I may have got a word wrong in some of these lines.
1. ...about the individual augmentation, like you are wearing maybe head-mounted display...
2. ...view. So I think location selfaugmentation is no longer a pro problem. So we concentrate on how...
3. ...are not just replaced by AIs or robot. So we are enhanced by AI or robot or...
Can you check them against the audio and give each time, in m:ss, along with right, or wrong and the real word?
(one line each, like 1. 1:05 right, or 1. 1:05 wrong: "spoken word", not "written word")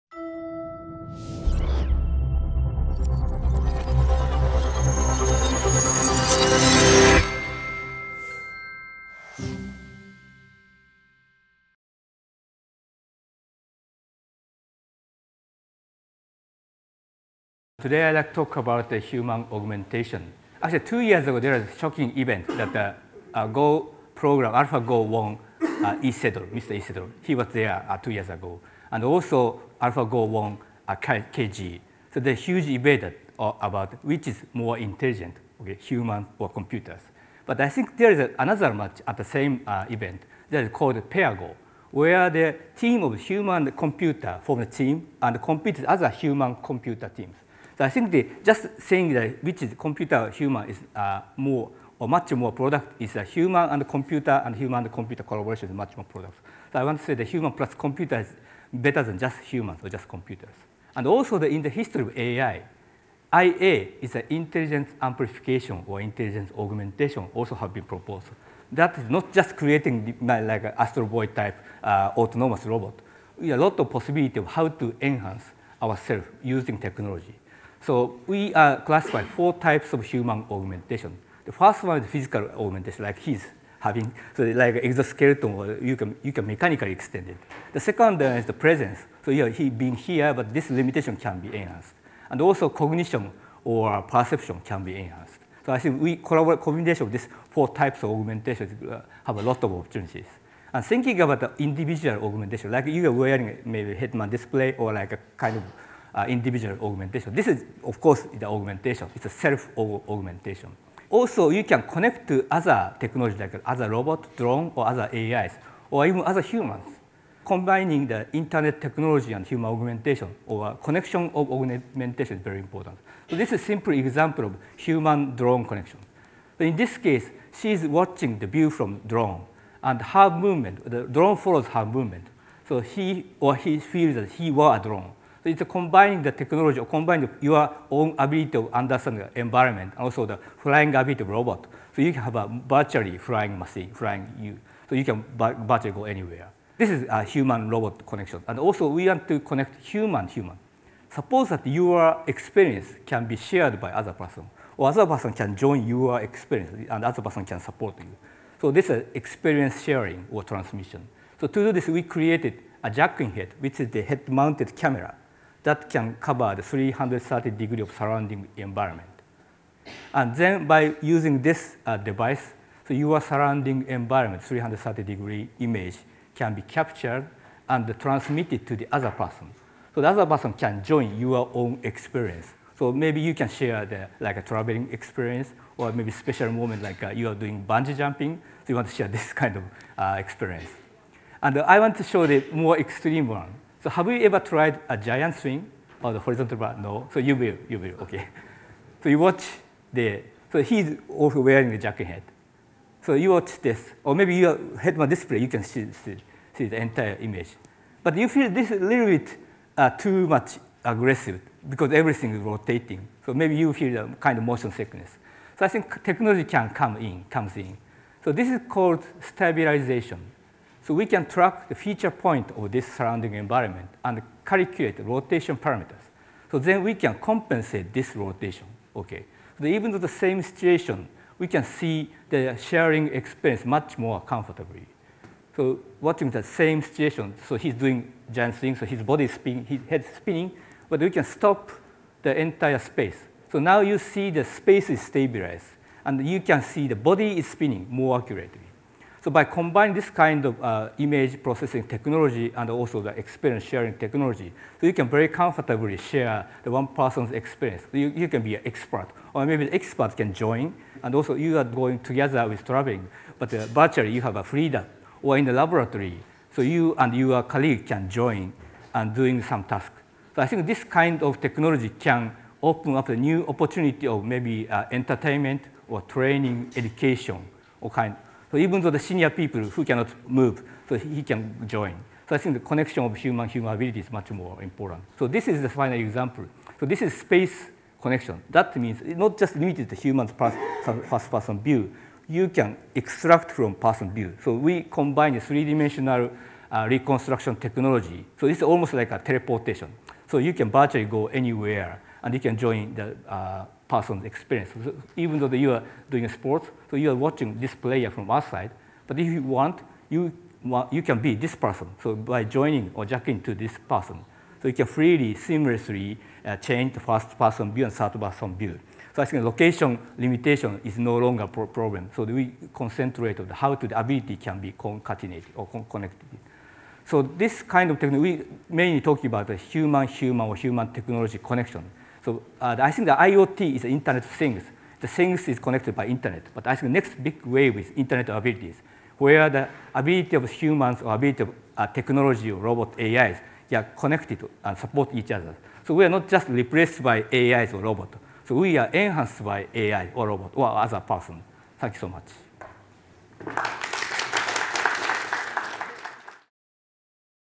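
1. 1:41 right
2. 5:18 wrong: "limitation", not "selfaugmentation"
3. 5:46 right.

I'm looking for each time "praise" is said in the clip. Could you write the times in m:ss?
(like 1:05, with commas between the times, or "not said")
not said.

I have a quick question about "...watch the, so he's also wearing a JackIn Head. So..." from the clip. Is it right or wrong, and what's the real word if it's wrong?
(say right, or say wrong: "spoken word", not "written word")
right.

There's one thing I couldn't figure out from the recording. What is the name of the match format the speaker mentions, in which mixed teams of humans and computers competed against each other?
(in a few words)
pair go.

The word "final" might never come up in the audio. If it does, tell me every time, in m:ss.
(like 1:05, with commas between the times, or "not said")
4:45.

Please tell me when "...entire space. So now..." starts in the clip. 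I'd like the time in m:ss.
4:02.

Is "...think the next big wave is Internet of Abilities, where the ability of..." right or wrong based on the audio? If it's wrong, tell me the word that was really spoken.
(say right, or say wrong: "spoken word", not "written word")
right.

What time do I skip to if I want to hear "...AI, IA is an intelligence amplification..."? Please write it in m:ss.
1:02.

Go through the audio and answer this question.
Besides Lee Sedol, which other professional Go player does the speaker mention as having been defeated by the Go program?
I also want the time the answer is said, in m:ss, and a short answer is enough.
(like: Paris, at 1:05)
Ke Jie, at 0:30.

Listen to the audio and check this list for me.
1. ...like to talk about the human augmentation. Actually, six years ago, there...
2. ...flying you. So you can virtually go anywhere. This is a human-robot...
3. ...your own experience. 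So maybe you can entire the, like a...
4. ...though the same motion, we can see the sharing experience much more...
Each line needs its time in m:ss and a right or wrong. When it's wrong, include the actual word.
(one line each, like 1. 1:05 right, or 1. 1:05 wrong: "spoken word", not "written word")
1. 0:18 wrong: "two", not "six"
2. 2:23 right
3. 3:01 wrong: "share", not "entire"
4. 3:49 wrong: "situation", not "motion".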